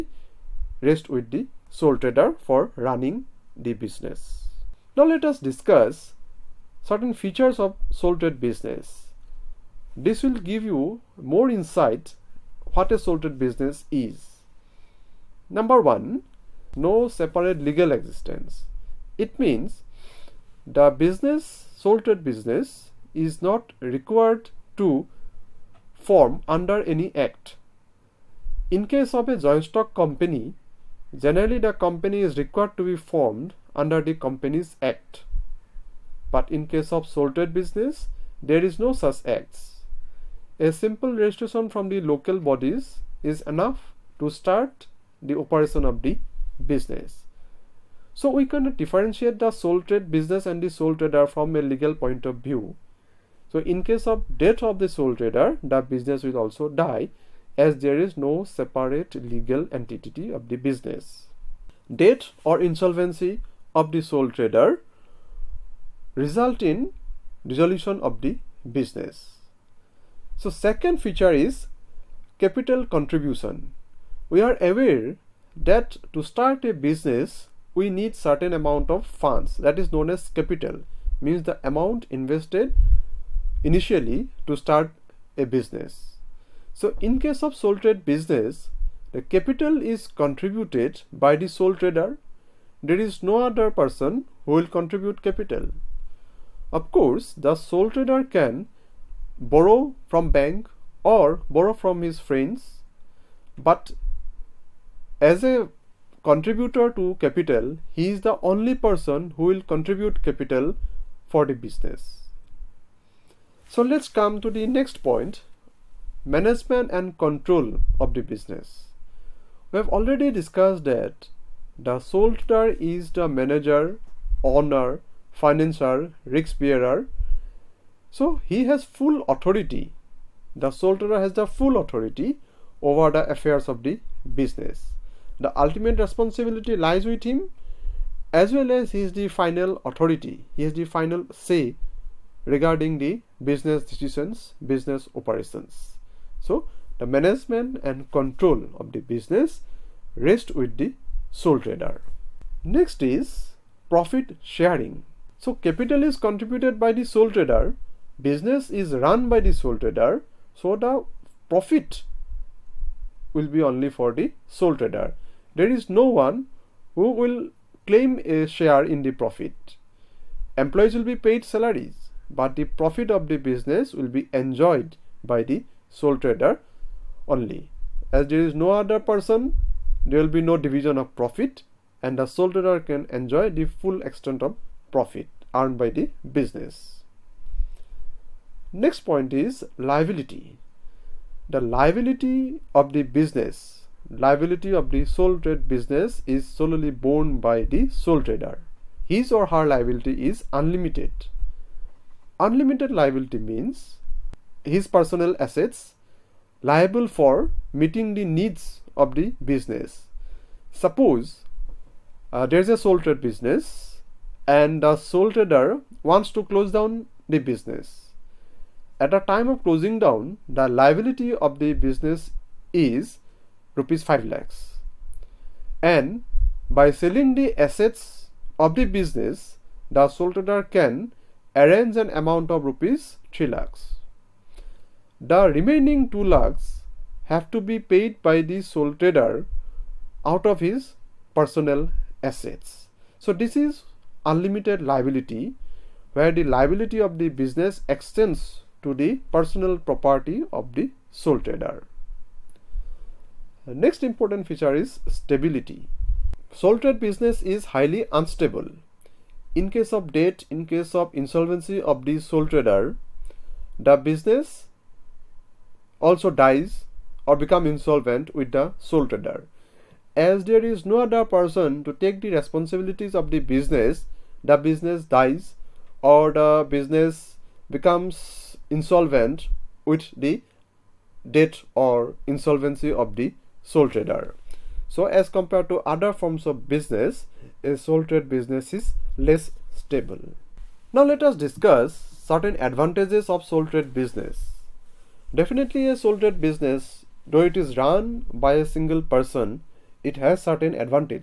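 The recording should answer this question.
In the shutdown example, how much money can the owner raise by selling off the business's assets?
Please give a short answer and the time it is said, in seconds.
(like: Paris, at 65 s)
3 lakh rupees, at 232 s.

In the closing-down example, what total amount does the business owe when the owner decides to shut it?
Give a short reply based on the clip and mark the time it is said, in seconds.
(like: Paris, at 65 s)
5 lakh rupees, at 223 s.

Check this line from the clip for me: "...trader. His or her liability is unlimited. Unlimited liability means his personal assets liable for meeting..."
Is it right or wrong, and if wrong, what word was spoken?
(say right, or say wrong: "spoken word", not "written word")
right.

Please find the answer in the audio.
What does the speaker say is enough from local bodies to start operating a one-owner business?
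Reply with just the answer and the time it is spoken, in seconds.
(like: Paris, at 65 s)
A simple registration, at 40 s.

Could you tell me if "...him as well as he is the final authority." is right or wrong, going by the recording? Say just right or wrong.
right.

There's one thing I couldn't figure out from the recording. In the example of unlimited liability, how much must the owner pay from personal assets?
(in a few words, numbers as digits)
2 lakh rupees.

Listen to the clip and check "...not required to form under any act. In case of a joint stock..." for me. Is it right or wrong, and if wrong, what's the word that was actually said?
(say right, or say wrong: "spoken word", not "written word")
right.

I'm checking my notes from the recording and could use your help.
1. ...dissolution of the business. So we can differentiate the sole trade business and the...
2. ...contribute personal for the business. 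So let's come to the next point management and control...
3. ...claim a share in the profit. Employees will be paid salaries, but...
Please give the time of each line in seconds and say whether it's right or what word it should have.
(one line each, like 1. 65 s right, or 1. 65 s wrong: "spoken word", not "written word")
1. 45 s wrong: "operation", not "dissolution"
2. 109 s wrong: "capital", not "personal"
3. 167 s right.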